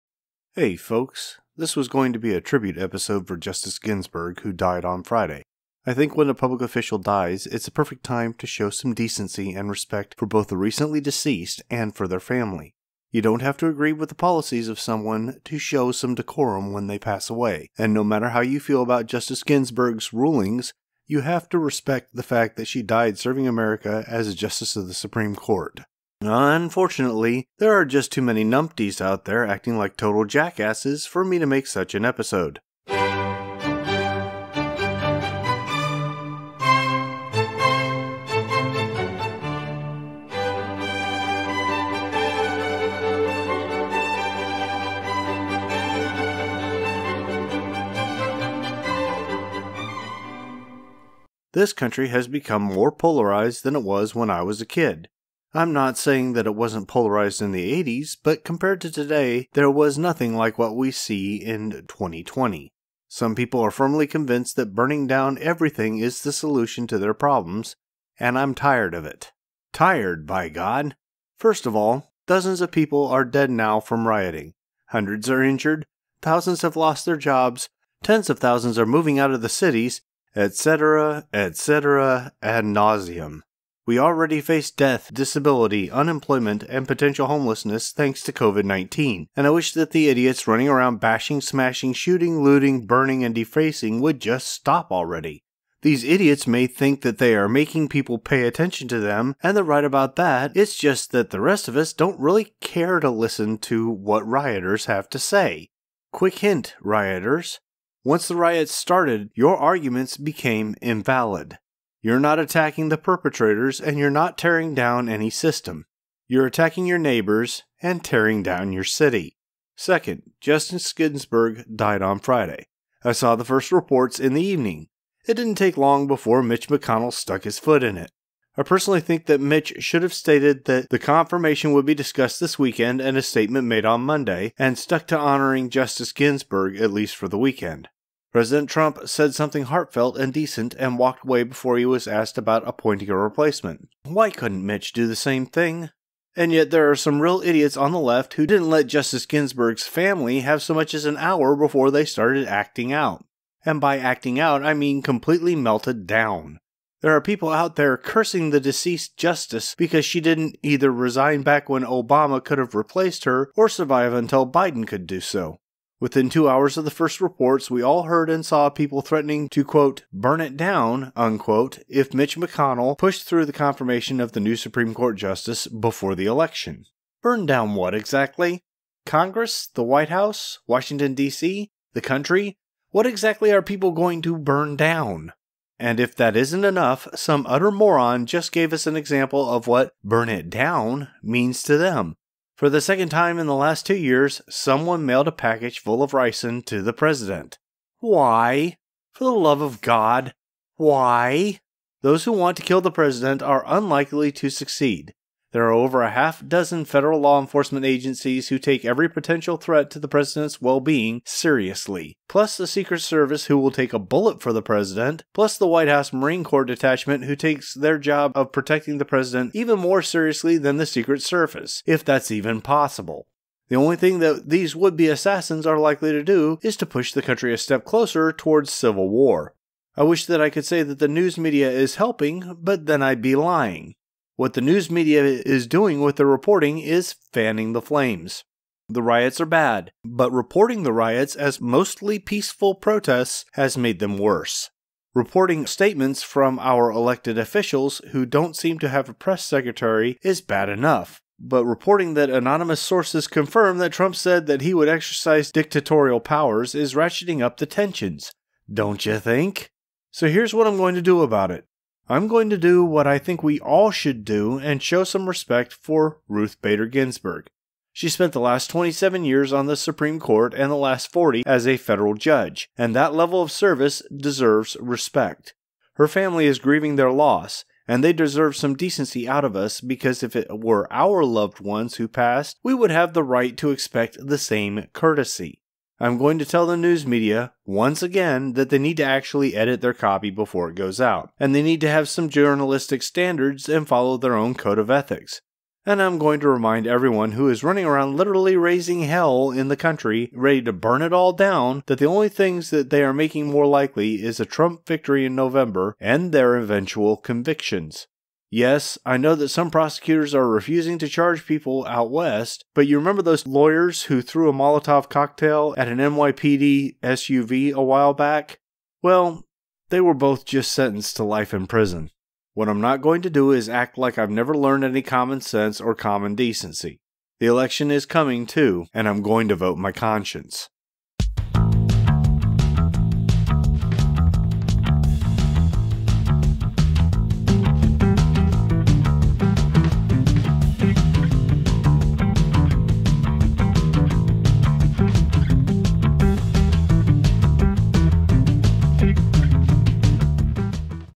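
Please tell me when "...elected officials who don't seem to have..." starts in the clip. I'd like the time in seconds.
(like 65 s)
246 s.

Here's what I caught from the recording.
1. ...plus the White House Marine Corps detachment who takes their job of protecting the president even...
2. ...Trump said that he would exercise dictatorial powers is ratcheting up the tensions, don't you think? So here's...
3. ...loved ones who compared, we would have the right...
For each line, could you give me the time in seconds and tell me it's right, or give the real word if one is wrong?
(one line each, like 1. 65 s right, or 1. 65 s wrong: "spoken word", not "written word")
1. 215 s right
2. 253 s right
3. 281 s wrong: "passed", not "compared".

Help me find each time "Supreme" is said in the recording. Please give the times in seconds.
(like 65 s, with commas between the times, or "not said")
24 s, 174 s, 269 s.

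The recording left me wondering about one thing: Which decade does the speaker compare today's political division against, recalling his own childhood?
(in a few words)
80s.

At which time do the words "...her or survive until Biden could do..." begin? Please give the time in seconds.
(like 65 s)
163 s.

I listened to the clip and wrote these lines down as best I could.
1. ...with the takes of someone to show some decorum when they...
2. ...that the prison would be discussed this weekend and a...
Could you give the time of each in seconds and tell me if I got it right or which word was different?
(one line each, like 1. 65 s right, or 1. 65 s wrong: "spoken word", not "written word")
1. 13 s wrong: "policies", not "takes"
2. 130 s wrong: "confirmation", not "prison".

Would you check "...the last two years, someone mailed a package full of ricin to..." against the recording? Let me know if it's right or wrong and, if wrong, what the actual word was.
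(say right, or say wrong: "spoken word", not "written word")
right.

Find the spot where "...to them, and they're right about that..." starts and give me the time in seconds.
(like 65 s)
98 s.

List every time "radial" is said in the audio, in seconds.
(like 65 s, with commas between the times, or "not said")
not said.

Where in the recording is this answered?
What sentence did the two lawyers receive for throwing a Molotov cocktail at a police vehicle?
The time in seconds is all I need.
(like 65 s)
321 s.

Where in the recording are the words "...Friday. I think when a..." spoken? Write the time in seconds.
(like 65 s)
5 s.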